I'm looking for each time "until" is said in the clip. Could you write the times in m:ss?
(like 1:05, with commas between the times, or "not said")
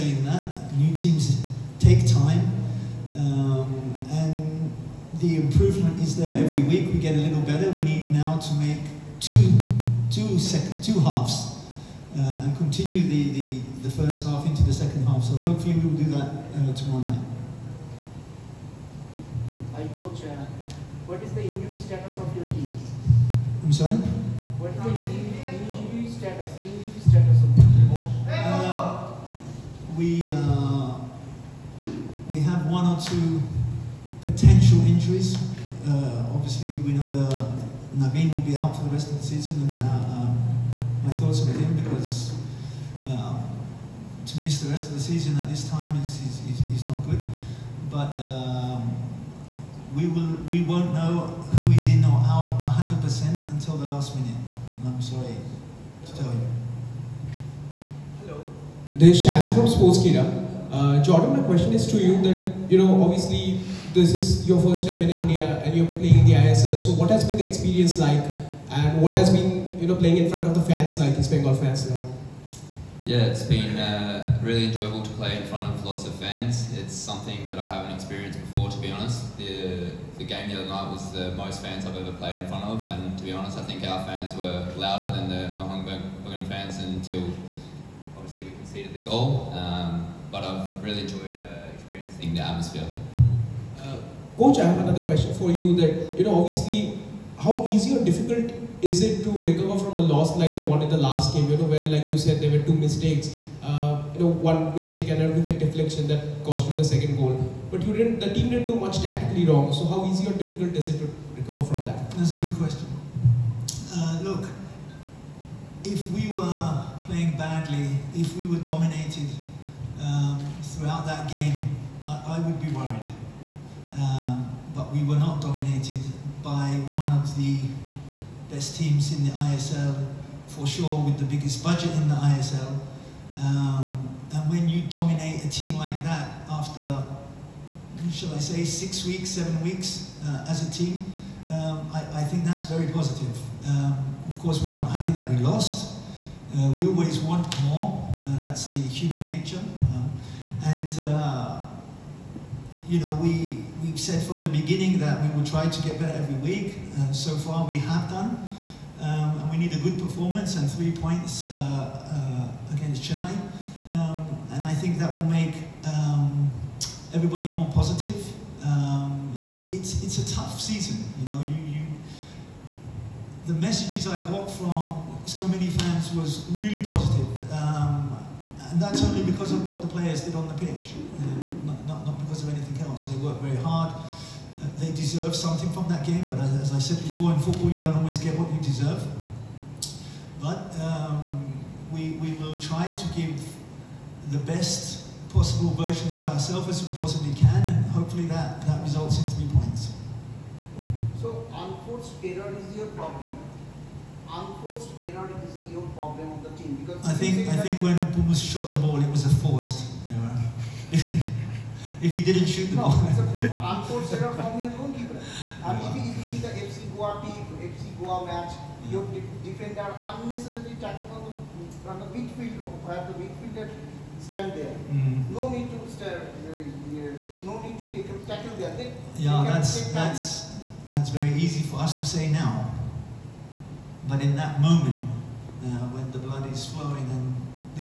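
0:53, 1:26.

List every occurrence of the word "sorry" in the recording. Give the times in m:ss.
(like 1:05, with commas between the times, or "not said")
0:23, 0:55.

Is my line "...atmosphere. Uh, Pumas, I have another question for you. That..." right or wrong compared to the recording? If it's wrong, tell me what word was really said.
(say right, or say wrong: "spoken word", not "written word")
wrong: "Coach", not "Pumas".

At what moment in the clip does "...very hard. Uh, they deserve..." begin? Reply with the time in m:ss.
3:03.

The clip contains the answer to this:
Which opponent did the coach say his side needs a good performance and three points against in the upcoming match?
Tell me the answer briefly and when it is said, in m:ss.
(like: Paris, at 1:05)
Chennai, at 2:43.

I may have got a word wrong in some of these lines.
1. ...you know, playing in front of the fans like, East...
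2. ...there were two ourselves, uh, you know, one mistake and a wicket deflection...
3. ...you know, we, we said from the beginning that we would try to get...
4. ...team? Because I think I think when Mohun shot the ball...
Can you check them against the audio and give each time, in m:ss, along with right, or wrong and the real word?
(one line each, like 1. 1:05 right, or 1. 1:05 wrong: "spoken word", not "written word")
1. 1:09 right
2. 1:42 wrong: "mistakes", not "ourselves"
3. 2:32 right
4. 3:26 wrong: "Pumas", not "Mohun".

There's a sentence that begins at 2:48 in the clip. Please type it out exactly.
Um, it, it's, it's a tough season, you know.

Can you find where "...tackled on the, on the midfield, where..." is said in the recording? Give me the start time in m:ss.
3:40.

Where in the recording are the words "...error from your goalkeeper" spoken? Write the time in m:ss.
3:34.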